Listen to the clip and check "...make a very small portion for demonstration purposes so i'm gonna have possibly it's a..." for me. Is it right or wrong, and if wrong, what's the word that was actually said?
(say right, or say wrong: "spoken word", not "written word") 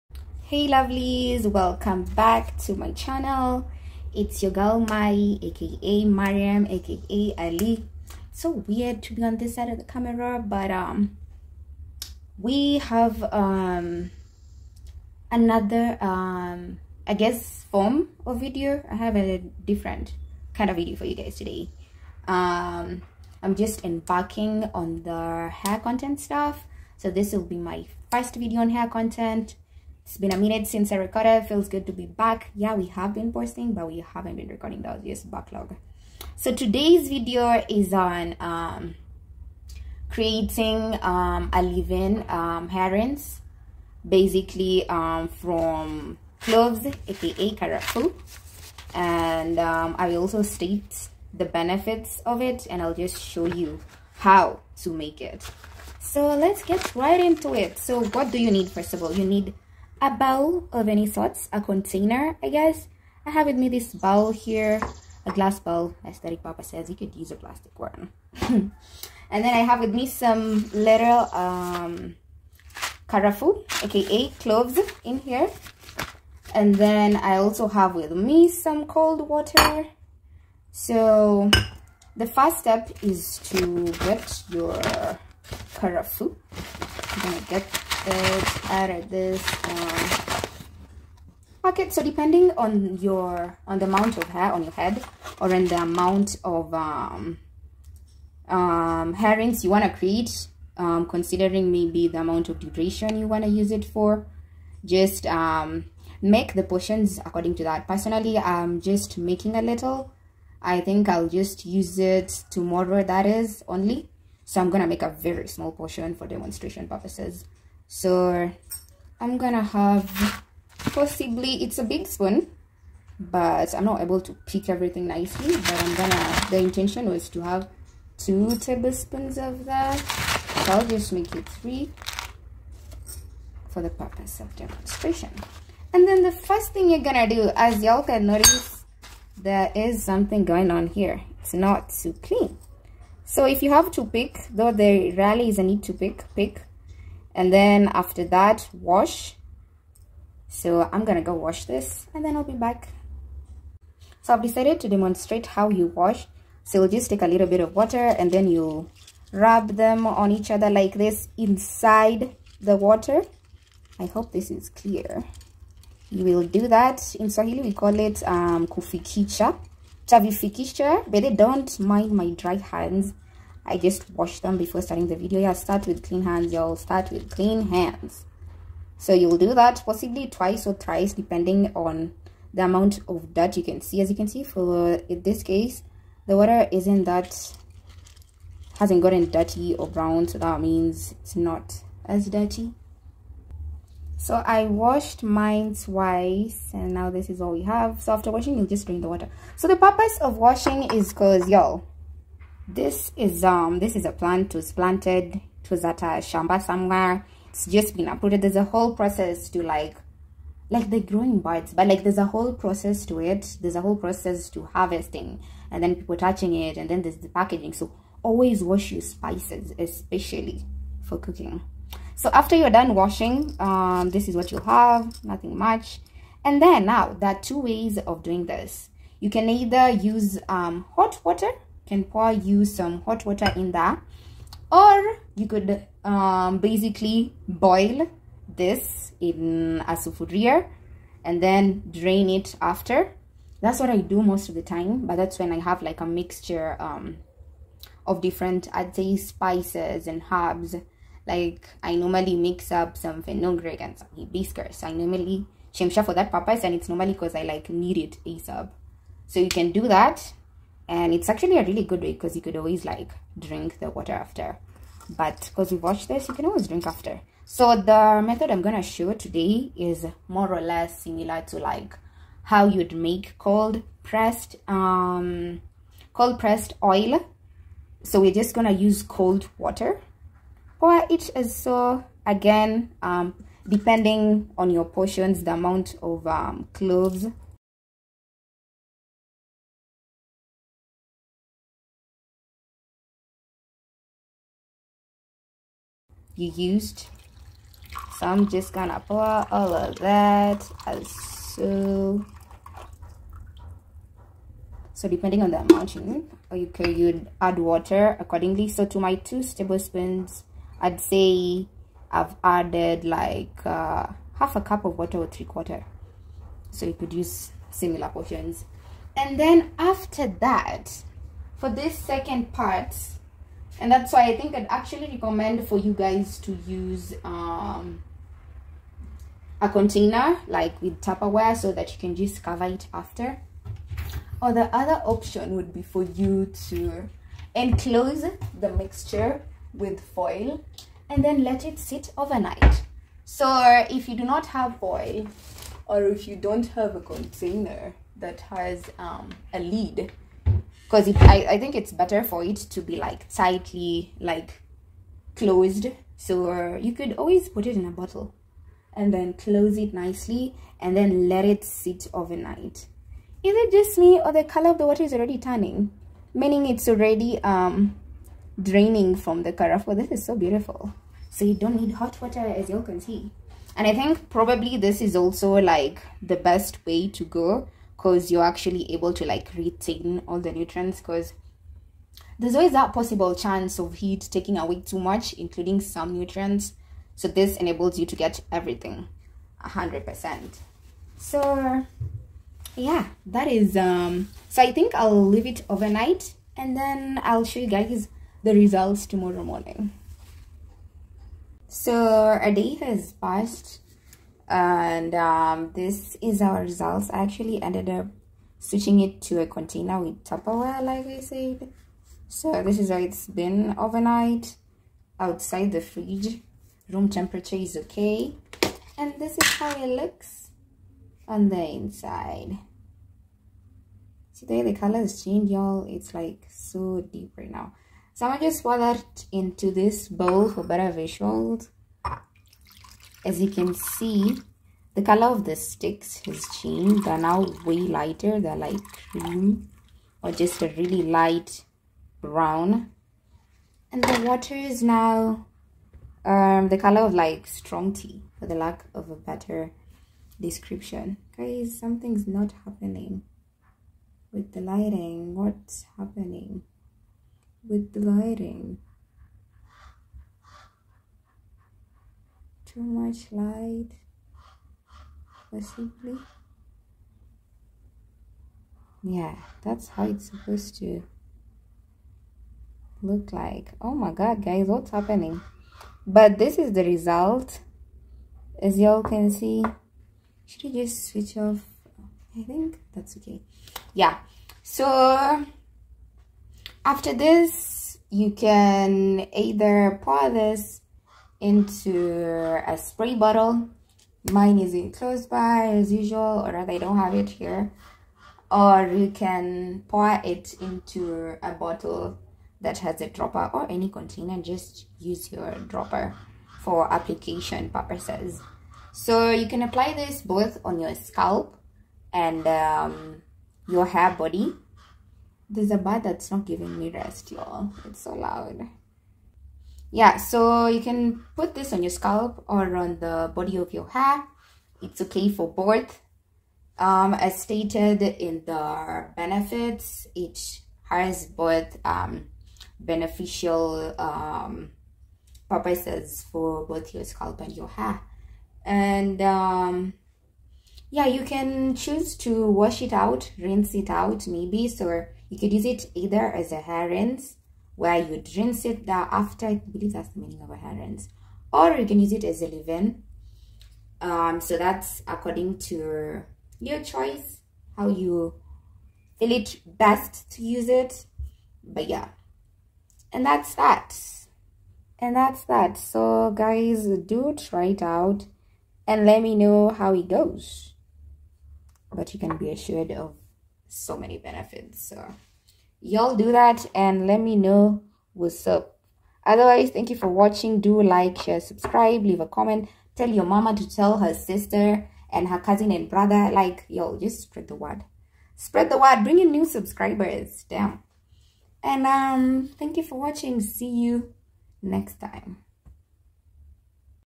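right.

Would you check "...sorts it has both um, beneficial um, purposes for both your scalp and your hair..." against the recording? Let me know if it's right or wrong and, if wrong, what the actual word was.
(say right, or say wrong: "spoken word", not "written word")
wrong: "benefits", not "sorts".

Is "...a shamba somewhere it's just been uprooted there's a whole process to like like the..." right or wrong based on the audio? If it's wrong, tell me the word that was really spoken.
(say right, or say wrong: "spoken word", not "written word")
right.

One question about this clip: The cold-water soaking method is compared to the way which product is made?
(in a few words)
cold pressed oil.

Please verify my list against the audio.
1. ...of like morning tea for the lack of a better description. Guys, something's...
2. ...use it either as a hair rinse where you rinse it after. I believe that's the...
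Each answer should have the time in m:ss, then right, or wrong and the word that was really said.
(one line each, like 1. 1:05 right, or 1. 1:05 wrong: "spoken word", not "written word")
1. 7:27 wrong: "strong", not "morning"
2. 9:05 right.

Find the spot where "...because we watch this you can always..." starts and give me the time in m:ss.
4:25.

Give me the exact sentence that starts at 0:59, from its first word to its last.
You need a bowl of any sorts, a container, I guess.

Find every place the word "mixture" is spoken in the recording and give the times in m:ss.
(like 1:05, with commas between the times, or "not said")
4:06, 5:38.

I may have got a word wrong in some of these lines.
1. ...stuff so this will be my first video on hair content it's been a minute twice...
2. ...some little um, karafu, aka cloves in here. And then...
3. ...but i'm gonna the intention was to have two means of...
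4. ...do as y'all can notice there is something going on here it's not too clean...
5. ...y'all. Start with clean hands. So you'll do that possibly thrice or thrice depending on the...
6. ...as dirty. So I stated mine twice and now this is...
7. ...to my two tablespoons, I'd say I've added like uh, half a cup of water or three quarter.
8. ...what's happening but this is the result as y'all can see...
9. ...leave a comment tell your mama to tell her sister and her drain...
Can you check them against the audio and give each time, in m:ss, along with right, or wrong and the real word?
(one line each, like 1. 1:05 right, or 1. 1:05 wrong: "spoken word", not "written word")
1. 0:26 wrong: "since", not "twice"
2. 1:10 right
3. 2:05 wrong: "tablespoons", not "means"
4. 2:17 right
5. 2:56 wrong: "twice", not "thrice"
6. 3:12 wrong: "washed", not "stated"
7. 5:08 right
8. 7:54 right
9. 9:42 wrong: "cousin", not "drain".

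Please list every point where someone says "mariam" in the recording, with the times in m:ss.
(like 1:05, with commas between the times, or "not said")
0:06.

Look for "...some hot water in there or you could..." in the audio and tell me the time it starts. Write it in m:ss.
3:52.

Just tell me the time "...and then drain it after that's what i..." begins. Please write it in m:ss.
4:01.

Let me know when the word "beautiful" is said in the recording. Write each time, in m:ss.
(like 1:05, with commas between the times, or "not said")
6:10.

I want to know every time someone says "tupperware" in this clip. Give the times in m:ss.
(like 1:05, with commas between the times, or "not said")
5:31, 6:50.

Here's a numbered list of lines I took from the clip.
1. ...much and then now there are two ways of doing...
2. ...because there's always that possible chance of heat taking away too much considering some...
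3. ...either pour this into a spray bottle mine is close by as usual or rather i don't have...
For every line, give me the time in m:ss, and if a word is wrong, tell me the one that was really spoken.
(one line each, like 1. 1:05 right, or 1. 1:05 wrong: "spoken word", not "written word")
1. 3:45 right
2. 6:21 wrong: "including", not "considering"
3. 8:09 right.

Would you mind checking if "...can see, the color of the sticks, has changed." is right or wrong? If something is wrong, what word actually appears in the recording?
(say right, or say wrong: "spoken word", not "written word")
right.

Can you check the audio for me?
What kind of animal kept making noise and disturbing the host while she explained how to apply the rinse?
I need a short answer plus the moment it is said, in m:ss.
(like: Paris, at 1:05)
a bird, at 8:35.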